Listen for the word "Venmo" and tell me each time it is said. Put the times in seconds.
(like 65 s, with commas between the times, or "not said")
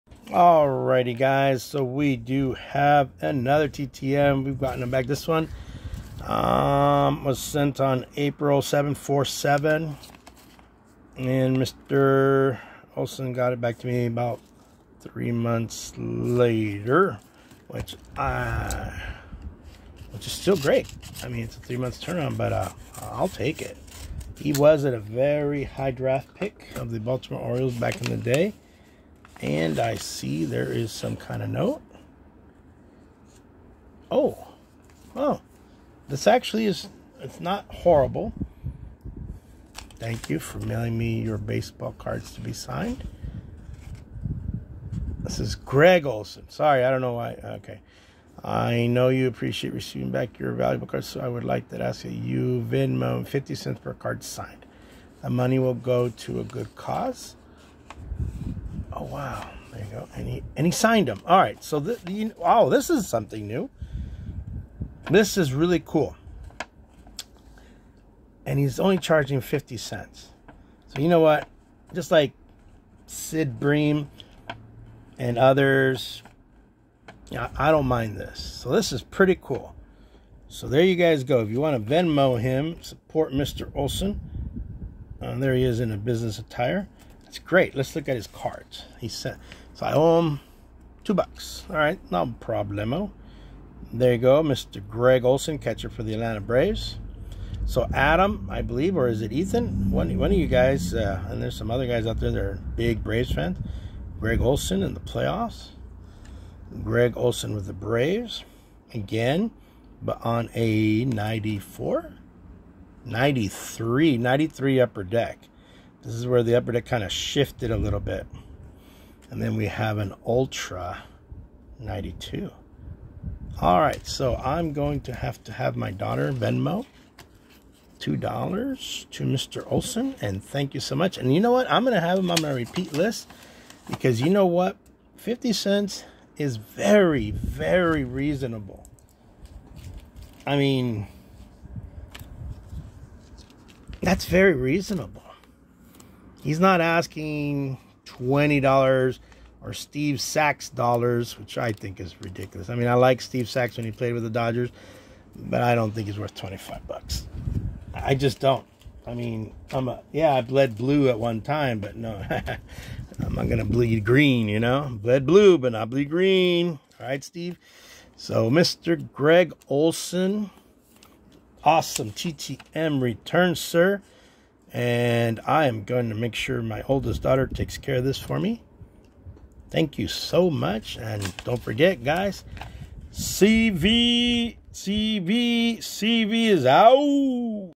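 52 s, 81 s, 126 s.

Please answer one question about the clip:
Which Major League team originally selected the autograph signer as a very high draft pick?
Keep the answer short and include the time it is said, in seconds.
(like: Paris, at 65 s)
Baltimore Orioles, at 27 s.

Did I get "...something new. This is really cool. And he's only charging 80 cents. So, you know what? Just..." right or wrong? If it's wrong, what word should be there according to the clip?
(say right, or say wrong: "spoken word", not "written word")
wrong: "50", not "80".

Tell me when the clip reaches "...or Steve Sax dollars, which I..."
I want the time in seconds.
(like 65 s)
149 s.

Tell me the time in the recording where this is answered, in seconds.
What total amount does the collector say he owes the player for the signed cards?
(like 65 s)
91 s.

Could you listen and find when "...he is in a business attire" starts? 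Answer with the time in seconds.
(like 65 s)
85 s.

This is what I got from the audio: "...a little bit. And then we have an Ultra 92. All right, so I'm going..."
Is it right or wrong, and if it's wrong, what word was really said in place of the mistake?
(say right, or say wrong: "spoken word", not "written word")
right.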